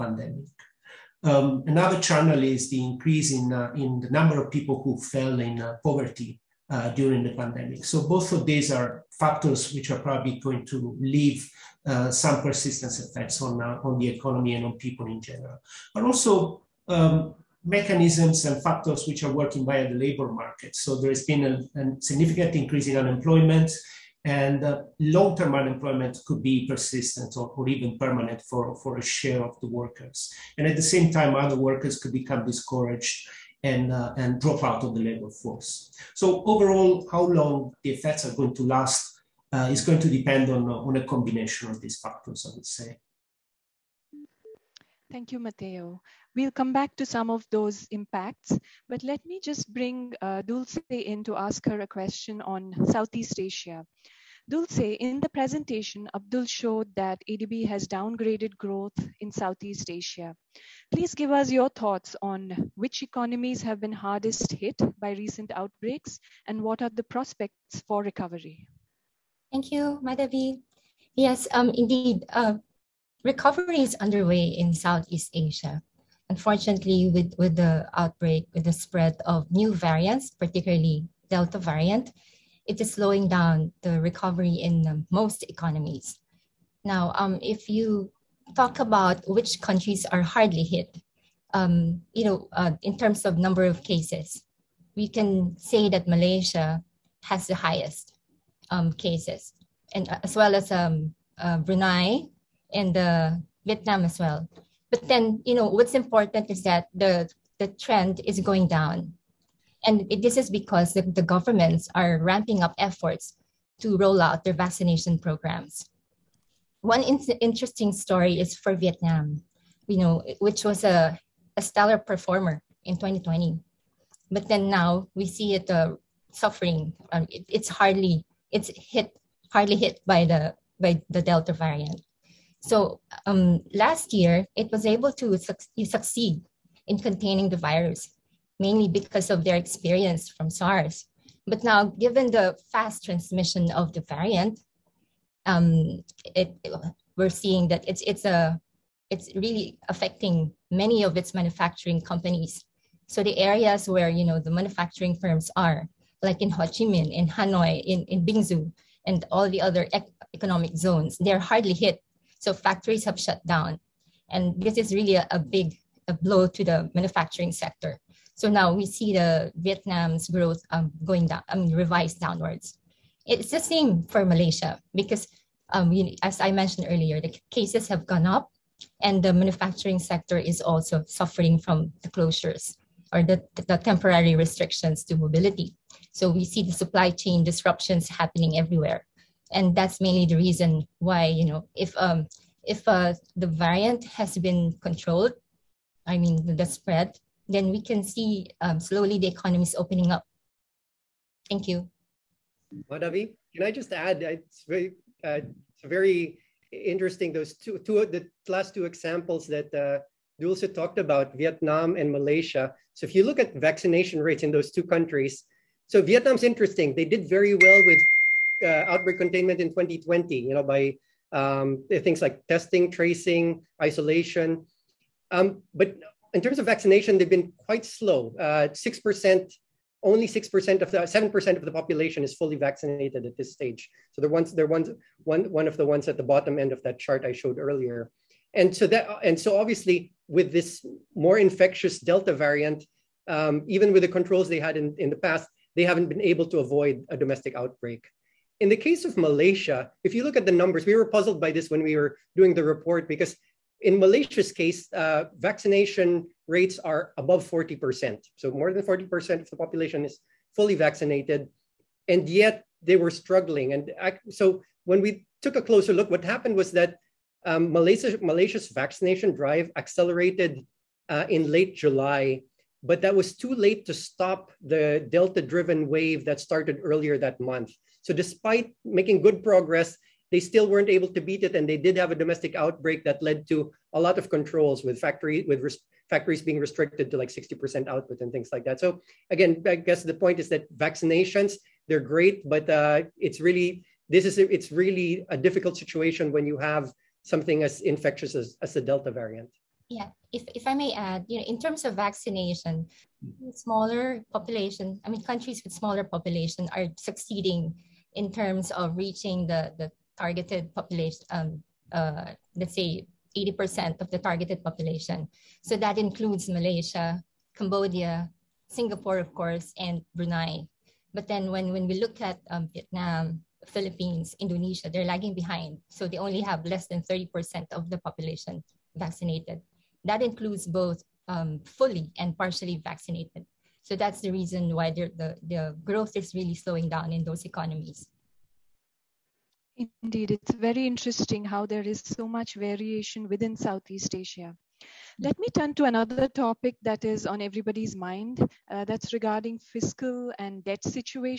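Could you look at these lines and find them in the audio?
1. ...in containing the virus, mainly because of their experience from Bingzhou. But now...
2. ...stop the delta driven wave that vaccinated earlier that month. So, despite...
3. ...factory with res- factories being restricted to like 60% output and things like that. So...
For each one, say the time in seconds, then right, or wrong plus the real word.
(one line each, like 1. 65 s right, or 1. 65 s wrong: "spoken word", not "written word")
1. 136 s wrong: "SARS", not "Bingzhou"
2. 273 s wrong: "started", not "vaccinated"
3. 284 s right.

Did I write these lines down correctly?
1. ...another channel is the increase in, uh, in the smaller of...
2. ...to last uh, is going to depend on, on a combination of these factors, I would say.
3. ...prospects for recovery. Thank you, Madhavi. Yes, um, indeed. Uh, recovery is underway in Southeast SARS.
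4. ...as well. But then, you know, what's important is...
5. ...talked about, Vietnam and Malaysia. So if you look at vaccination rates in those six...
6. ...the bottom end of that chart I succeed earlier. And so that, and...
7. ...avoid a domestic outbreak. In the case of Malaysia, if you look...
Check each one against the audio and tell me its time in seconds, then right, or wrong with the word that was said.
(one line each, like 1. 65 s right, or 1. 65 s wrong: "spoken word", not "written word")
1. 1 s wrong: "number", not "smaller"
2. 38 s right
3. 67 s wrong: "Asia", not "SARS"
4. 104 s right
5. 210 s wrong: "two", not "six"
6. 236 s wrong: "showed", not "succeed"
7. 246 s right.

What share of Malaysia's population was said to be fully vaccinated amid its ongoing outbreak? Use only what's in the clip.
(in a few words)
Above 40%.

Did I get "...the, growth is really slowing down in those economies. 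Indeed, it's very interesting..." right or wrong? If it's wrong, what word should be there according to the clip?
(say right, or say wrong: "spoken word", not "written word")
right.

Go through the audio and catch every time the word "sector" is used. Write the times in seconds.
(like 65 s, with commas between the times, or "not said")
167 s, 179 s.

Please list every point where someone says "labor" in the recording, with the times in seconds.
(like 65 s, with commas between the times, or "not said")
19 s, 35 s.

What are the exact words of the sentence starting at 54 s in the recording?
Dulce, in the presentation, Abdul showed that ADB has downgraded growth in Southeast Asia.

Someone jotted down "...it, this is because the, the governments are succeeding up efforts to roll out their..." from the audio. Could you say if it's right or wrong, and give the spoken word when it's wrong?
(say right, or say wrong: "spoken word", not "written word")
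wrong: "ramping", not "succeeding".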